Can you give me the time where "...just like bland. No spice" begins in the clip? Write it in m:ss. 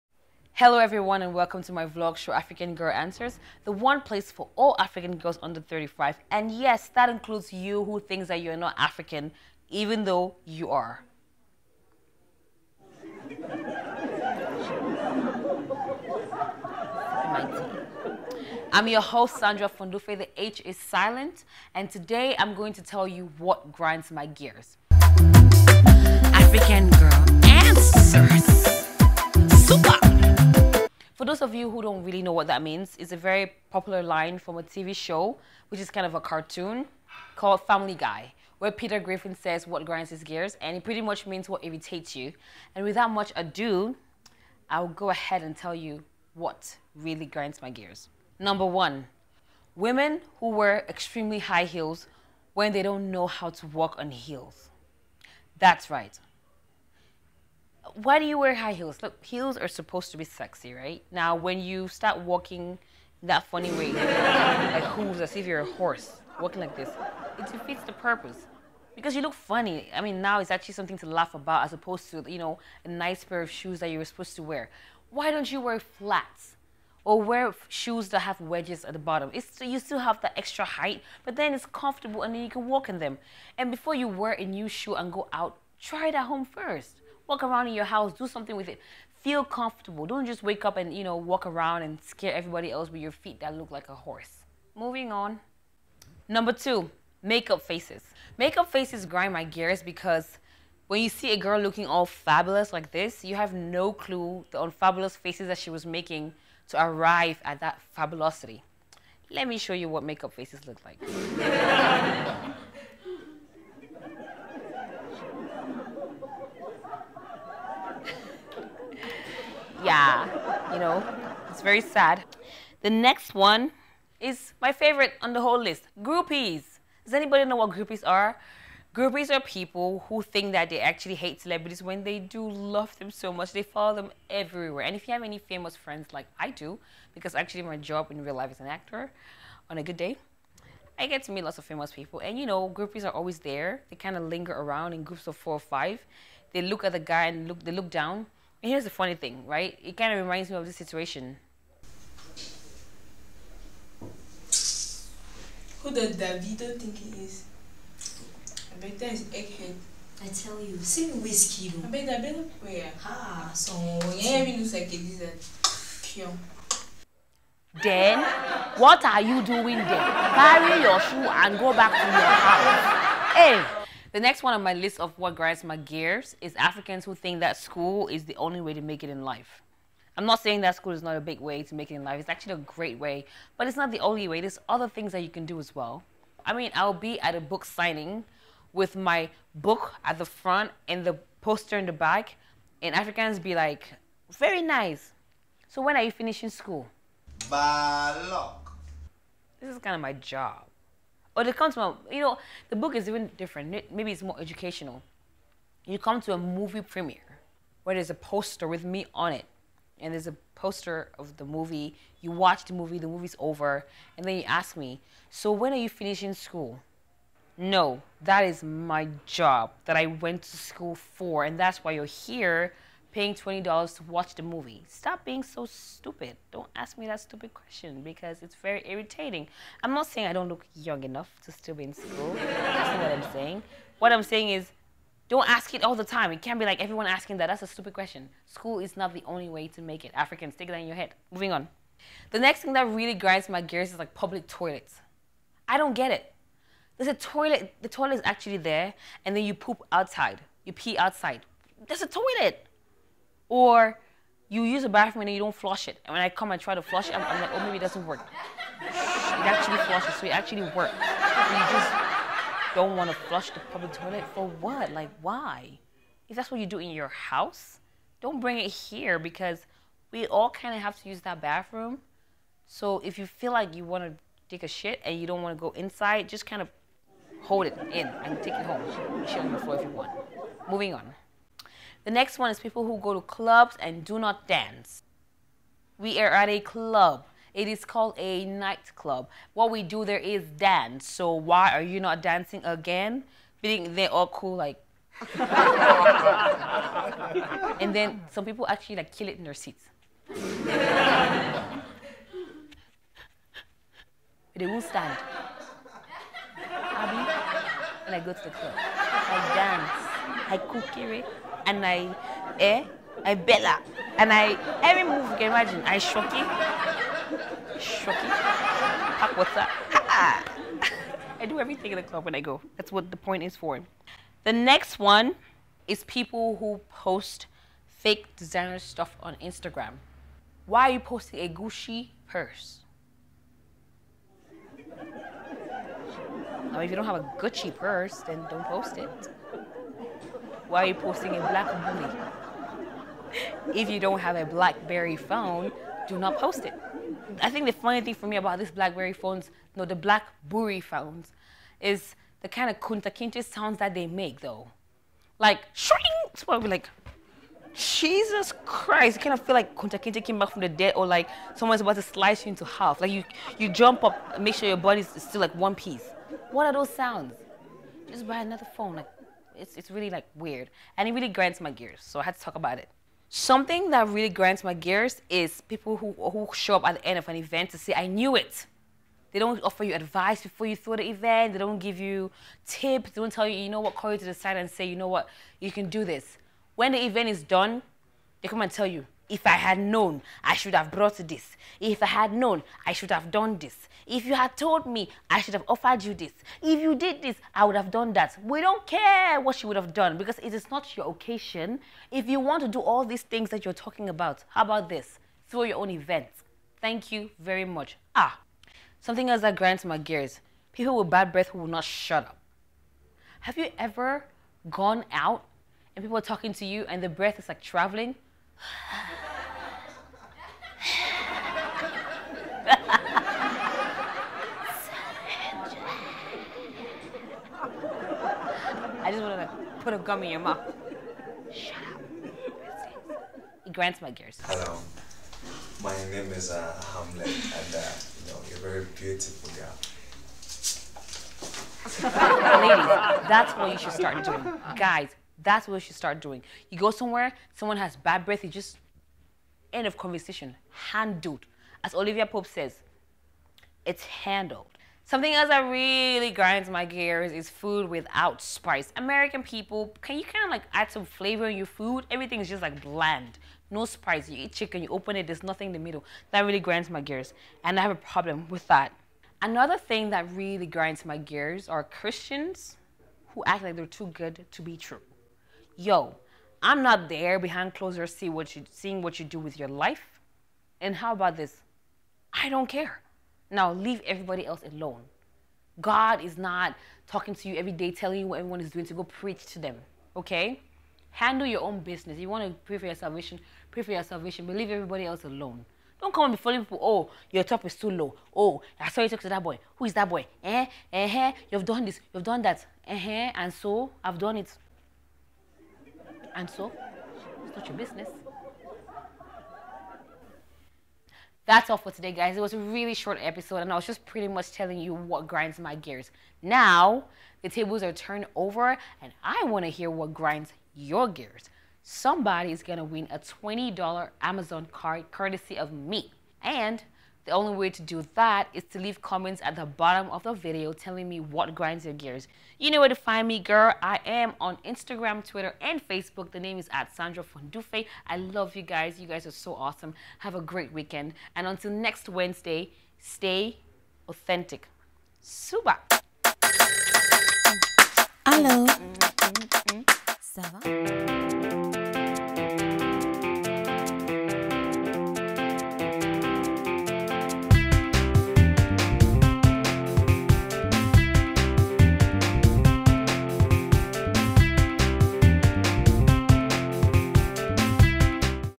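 7:42.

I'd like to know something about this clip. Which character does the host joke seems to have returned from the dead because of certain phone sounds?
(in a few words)
Kunta Kinte.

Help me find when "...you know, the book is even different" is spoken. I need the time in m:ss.
3:22.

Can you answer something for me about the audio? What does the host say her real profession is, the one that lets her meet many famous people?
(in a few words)
actor.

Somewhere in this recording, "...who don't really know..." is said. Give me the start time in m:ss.
0:31.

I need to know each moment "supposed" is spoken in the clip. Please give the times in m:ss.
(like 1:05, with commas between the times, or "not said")
0:59, 1:14.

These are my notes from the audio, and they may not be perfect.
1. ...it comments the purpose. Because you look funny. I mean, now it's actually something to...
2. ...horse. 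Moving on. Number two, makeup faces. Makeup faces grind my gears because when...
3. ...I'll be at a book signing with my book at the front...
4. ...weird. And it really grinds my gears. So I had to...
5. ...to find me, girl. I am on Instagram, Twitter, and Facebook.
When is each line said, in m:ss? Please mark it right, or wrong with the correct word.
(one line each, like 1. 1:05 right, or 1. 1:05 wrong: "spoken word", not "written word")
1. 1:07 wrong: "defeats", not "comments"
2. 1:33 right
3. 3:06 right
4. 6:10 right
5. 8:52 right.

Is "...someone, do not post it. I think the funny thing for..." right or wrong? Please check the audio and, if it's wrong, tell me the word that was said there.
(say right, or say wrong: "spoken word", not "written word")
wrong: "phone", not "someone".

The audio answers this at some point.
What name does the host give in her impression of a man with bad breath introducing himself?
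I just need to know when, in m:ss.
7:16.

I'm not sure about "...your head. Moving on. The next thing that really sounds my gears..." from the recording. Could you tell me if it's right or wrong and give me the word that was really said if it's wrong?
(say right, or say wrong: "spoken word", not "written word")
wrong: "grinds", not "sounds".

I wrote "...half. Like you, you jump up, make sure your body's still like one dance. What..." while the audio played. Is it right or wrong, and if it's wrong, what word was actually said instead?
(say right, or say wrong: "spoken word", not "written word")
wrong: "piece", not "dance".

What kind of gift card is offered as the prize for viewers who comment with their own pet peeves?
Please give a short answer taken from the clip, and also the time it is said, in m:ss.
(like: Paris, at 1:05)
Amazon card, at 8:44.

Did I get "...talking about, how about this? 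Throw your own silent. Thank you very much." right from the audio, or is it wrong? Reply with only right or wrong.
wrong.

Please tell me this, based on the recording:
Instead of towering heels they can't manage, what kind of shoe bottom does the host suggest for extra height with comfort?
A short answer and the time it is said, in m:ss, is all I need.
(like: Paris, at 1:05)
wedges, at 1:18.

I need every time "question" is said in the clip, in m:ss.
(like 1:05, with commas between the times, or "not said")
3:47, 3:57.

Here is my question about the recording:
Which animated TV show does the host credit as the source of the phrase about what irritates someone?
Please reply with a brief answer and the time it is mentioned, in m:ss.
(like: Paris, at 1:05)
Family Guy, at 0:37.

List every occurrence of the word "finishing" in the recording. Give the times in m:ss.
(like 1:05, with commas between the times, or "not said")
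3:16, 3:35.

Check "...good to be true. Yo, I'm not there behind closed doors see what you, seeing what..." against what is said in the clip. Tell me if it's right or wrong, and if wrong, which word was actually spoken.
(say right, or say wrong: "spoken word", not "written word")
right.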